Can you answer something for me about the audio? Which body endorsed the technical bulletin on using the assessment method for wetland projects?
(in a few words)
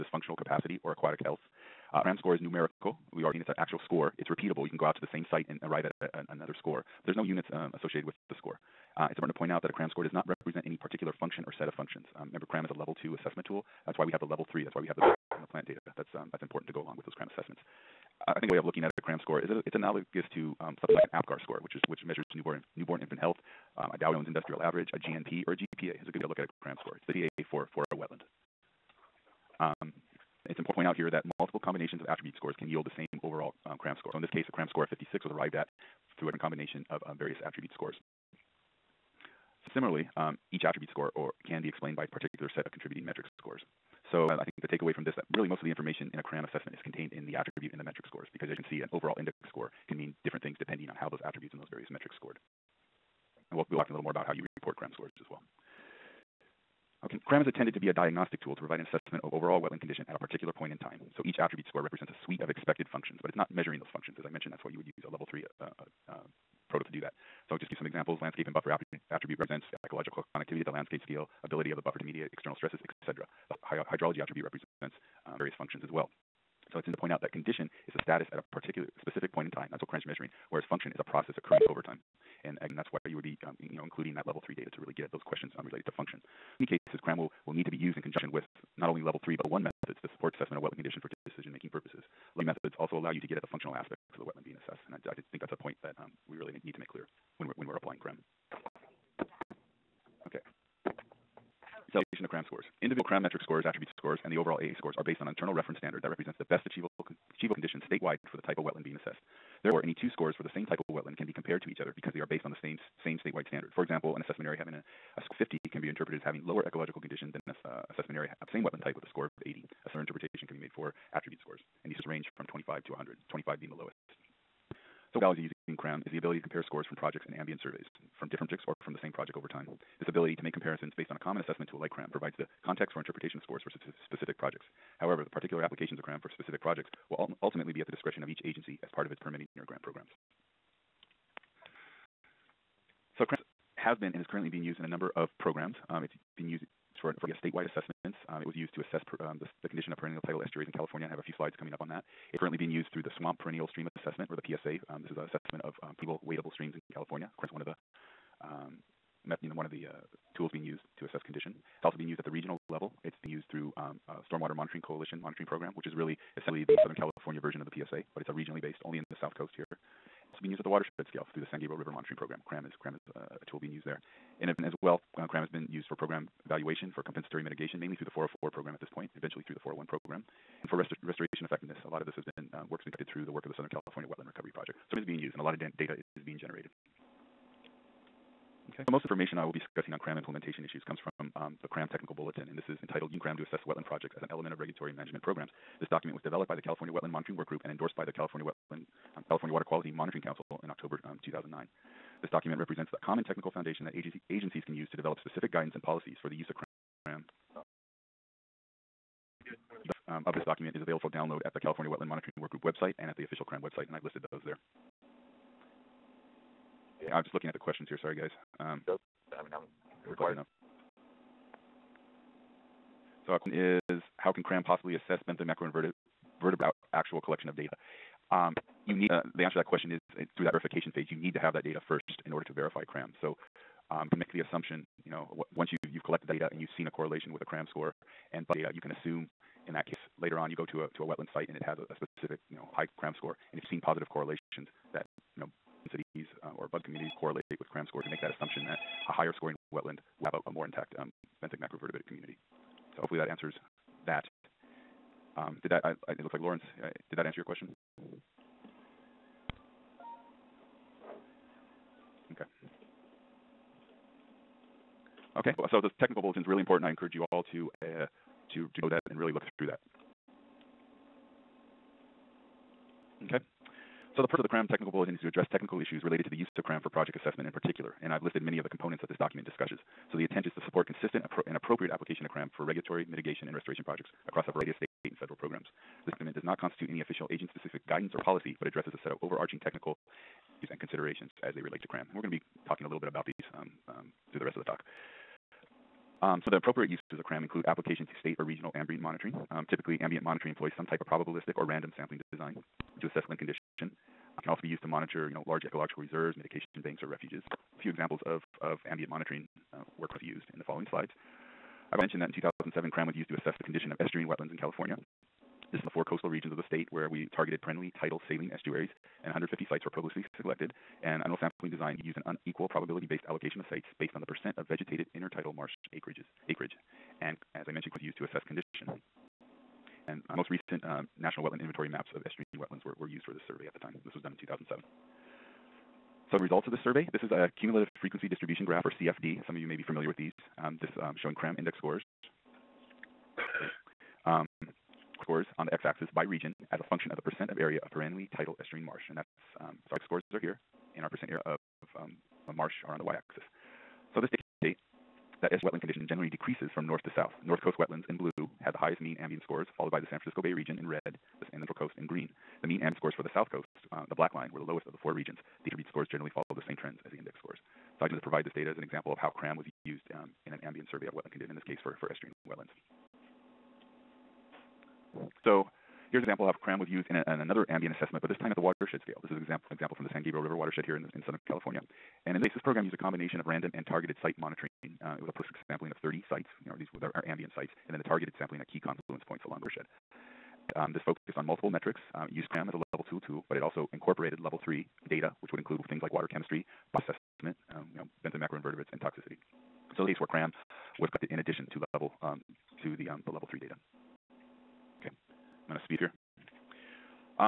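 California Water Quality Monitoring Council.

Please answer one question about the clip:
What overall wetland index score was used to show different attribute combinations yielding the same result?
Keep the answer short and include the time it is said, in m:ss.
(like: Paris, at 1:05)
56, at 0:34.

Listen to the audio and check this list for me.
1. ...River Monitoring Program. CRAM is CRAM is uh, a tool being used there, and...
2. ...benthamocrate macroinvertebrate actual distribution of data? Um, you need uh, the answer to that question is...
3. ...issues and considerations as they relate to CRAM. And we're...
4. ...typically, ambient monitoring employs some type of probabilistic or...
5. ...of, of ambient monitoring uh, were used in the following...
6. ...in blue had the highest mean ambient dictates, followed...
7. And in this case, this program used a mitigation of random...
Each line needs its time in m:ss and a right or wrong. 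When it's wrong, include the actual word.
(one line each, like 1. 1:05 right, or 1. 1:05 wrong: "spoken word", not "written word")
1. 2:51 right
2. 3:45 wrong: "collection", not "distribution"
3. 4:50 right
4. 4:59 right
5. 5:08 right
6. 5:58 wrong: "scores", not "dictates"
7. 6:22 wrong: "combination", not "mitigation".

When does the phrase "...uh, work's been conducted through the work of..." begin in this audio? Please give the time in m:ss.
3:02.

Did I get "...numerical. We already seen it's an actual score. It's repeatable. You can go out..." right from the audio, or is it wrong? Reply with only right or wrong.
right.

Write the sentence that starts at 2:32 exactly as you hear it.
It's currently being used through the Swamp Perennial Stream Assessment, or the PSA.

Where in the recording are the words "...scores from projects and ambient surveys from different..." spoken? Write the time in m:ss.
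2:06.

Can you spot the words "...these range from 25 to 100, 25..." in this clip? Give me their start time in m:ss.
2:01.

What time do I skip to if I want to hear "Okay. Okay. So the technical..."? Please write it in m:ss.
4:22.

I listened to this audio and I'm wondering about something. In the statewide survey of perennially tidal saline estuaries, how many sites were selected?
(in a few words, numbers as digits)
150.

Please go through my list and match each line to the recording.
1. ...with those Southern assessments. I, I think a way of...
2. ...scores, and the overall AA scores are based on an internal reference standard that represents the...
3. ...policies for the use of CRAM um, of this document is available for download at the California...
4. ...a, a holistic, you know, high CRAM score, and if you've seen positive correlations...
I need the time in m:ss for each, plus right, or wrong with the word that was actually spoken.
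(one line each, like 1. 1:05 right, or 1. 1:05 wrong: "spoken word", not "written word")
1. 0:16 wrong: "CRAM", not "Southern"
2. 1:43 right
3. 3:25 right
4. 4:01 wrong: "specific", not "holistic".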